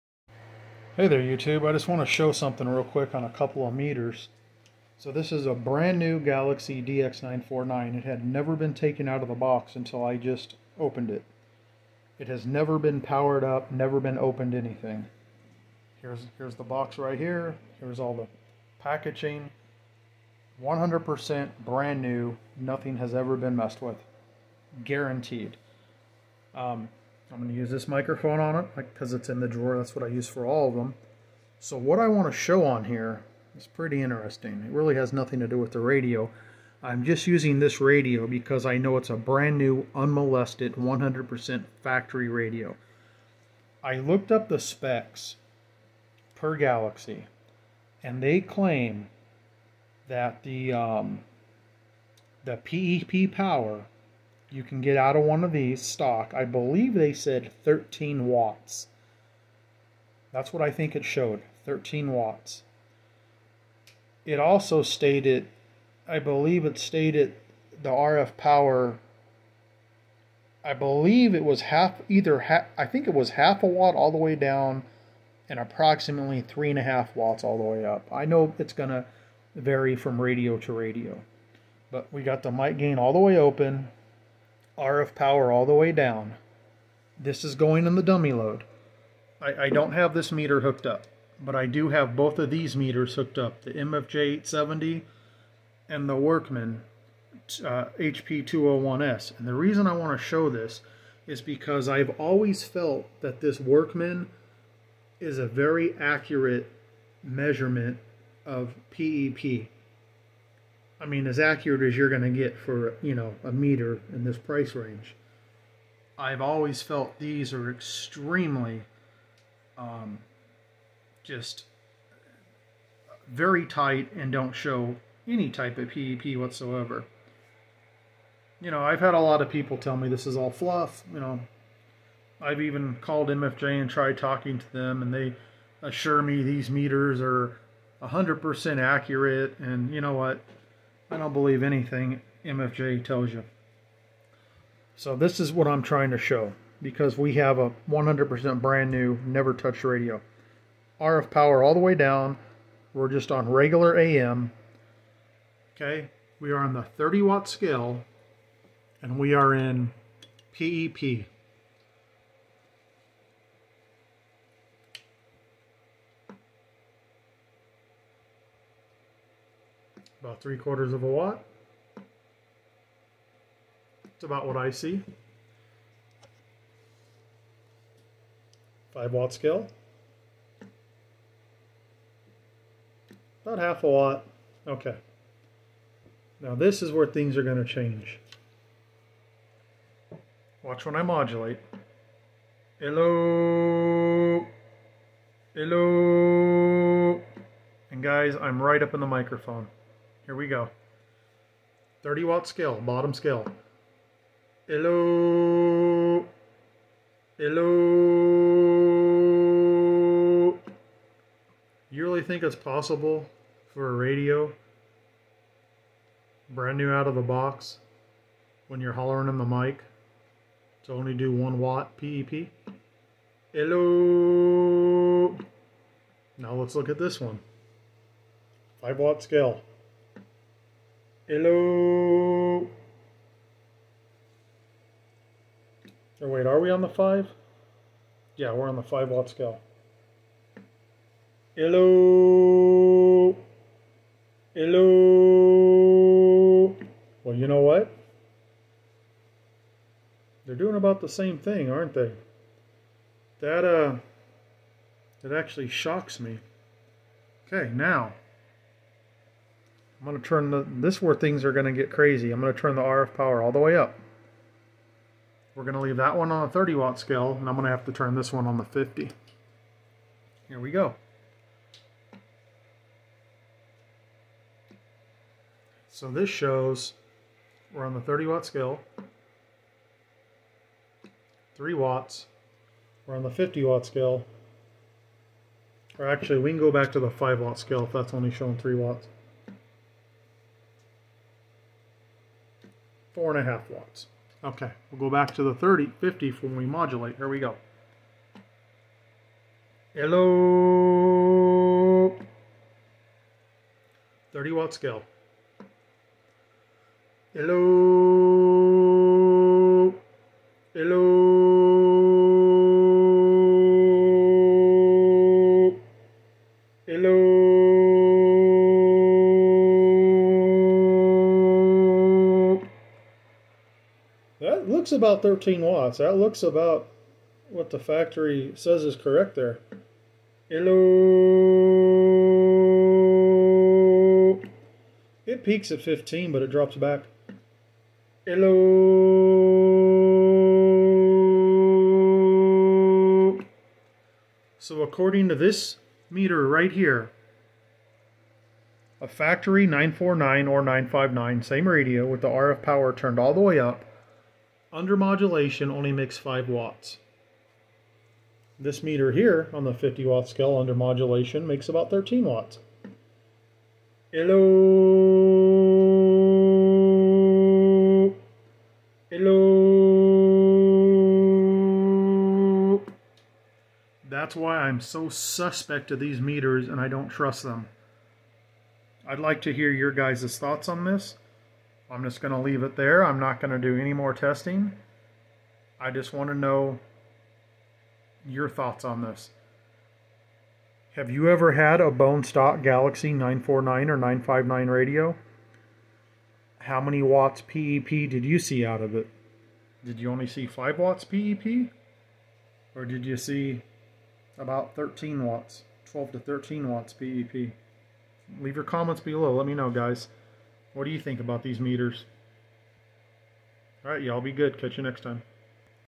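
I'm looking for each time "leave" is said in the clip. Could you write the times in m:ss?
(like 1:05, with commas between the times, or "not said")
4:25, 6:22, 6:48.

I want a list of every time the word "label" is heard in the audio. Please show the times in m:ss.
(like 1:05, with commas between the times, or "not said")
not said.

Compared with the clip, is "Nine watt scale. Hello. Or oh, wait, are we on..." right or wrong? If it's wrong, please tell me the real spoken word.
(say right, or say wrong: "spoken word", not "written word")
wrong: "Five", not "Nine".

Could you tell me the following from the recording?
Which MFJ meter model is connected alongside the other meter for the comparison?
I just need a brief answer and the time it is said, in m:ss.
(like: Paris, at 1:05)
MFJ870, at 1:33.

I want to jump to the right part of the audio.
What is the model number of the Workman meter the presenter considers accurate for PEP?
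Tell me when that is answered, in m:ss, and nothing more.
1:37.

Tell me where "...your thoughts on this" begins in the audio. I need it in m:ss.
6:28.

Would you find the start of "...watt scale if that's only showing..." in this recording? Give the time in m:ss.
4:47.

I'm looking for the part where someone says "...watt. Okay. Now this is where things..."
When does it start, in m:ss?
3:03.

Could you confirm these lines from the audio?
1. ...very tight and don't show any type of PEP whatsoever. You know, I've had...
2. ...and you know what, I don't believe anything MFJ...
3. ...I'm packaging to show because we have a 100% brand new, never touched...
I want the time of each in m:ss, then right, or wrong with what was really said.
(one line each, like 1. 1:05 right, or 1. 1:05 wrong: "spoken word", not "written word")
1. 2:03 right
2. 2:19 right
3. 2:25 wrong: "trying", not "packaging".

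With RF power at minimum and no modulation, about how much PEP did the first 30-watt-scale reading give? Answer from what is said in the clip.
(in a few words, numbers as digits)
three quarters of a watt.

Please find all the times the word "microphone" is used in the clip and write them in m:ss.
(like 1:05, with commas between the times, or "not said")
0:27, 3:19.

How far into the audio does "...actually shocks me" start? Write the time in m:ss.
4:15.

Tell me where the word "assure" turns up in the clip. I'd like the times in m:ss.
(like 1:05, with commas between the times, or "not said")
2:15.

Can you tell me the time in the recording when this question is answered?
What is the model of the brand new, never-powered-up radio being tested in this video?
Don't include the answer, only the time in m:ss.
0:06.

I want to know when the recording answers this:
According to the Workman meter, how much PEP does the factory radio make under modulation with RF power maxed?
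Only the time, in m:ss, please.
5:55.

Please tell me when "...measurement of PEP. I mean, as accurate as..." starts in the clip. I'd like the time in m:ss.
1:47.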